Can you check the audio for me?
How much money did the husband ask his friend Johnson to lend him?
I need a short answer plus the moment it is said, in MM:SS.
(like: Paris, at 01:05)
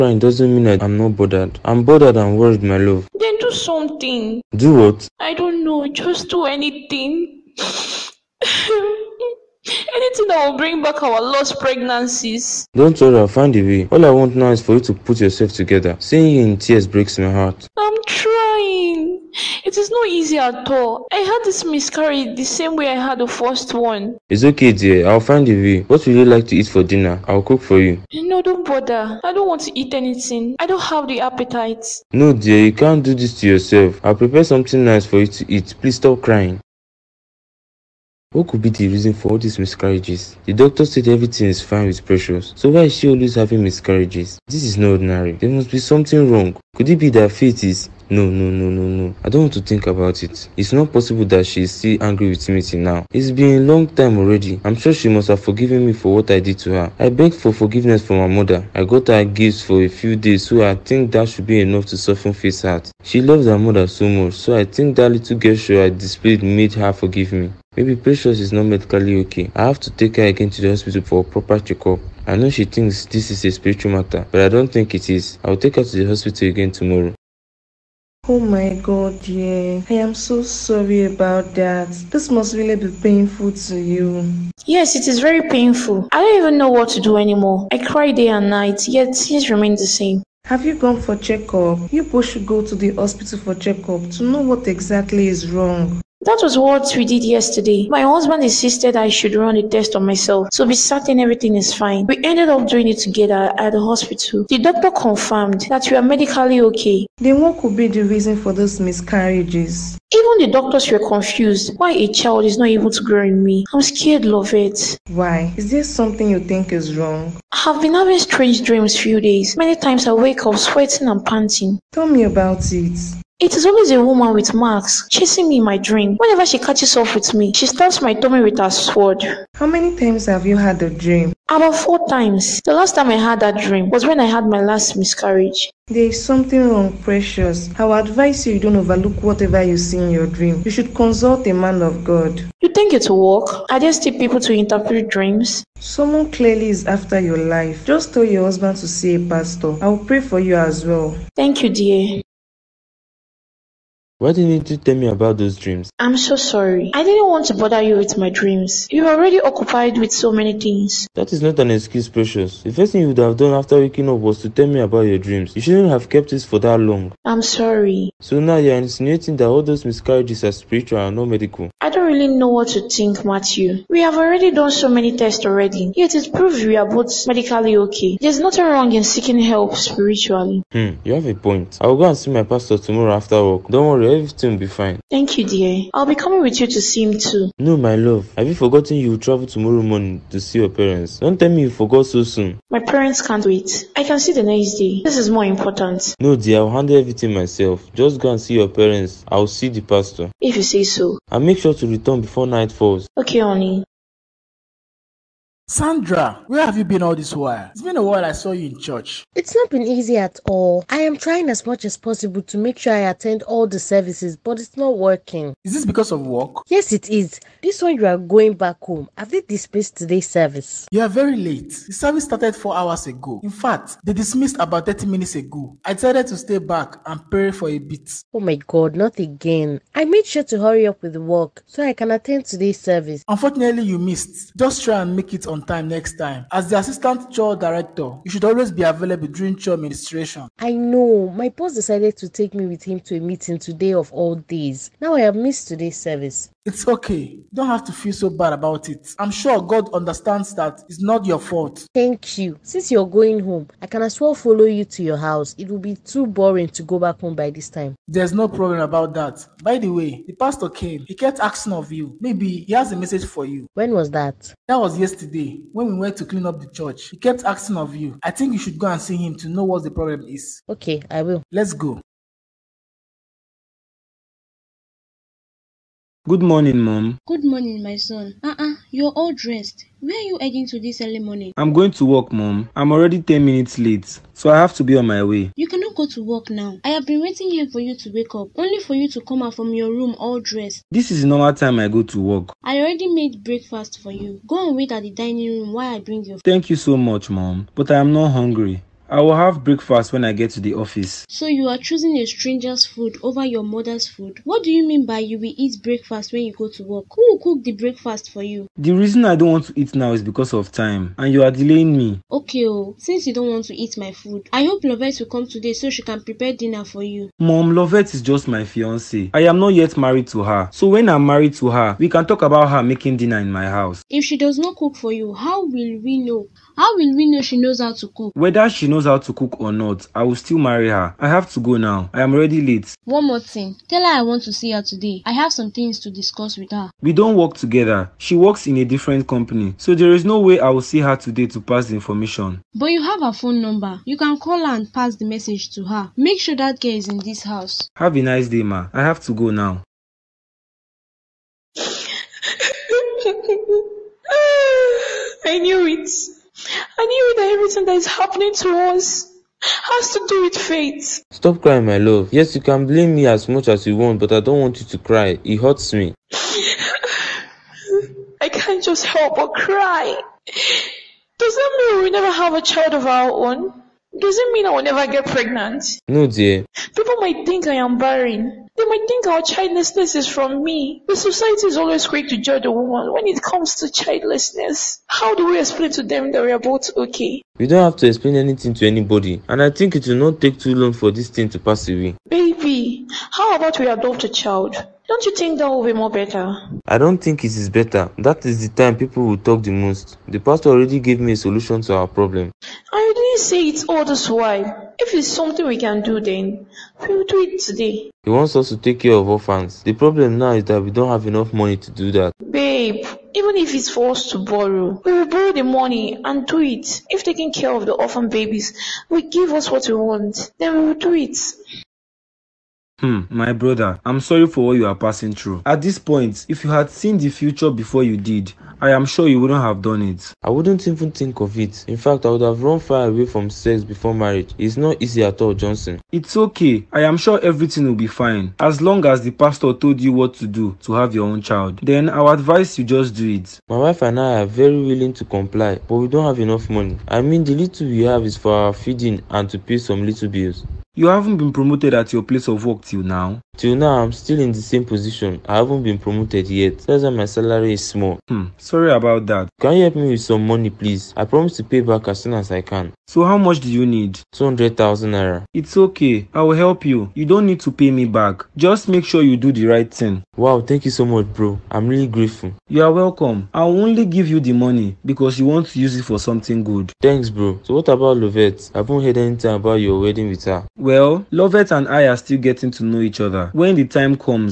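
200,000 naira, at 07:44.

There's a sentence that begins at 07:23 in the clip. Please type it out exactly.
My wife and I are very willing to comply, but we don't have enough money.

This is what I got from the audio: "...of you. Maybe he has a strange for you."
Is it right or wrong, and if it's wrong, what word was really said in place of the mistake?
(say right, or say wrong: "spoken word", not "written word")
wrong: "message", not "strange".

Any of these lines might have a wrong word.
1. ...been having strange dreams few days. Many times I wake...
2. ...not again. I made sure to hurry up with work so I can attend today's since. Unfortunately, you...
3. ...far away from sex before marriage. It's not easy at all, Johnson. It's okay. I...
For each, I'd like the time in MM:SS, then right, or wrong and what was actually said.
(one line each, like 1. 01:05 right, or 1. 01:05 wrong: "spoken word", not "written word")
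1. 01:57 right
2. 03:48 wrong: "service", not "since"
3. 07:12 right.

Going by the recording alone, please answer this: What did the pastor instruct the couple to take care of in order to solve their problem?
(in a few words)
Orphans.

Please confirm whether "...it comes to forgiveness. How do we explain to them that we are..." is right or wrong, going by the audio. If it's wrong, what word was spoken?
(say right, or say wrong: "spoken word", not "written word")
wrong: "childlessness", not "forgiveness".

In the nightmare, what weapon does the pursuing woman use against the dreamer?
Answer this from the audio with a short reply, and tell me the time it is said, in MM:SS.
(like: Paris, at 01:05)
Sword, at 02:08.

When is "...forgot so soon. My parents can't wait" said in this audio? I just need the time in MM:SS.
03:11.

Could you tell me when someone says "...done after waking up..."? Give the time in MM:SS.
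02:43.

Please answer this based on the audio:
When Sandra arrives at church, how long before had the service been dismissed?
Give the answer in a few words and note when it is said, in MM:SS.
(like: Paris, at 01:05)
About 30 minutes, at 03:44.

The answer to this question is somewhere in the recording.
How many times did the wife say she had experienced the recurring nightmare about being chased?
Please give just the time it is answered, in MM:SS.
02:11.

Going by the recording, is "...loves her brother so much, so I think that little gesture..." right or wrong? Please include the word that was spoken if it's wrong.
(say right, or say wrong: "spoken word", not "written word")
wrong: "mother", not "brother".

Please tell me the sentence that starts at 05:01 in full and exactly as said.
So you are choosing a stranger's food over your mother's food.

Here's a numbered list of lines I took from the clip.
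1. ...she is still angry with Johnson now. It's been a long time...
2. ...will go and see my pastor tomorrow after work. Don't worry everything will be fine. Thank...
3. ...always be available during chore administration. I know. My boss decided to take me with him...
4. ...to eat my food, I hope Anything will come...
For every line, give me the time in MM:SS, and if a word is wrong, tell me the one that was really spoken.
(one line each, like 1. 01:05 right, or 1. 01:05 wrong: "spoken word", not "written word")
1. 00:51 wrong: "Timothy", not "Johnson"
2. 03:01 right
3. 03:58 right
4. 05:13 wrong: "Lovette", not "Anything".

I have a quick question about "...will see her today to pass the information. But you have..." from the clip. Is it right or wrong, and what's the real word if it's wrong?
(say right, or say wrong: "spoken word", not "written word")
right.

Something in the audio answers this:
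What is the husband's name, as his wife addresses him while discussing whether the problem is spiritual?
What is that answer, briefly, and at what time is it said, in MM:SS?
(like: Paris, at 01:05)
Matthew, at 02:53.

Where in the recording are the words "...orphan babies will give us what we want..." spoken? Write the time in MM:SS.
06:57.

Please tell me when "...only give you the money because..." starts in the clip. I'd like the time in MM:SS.
07:53.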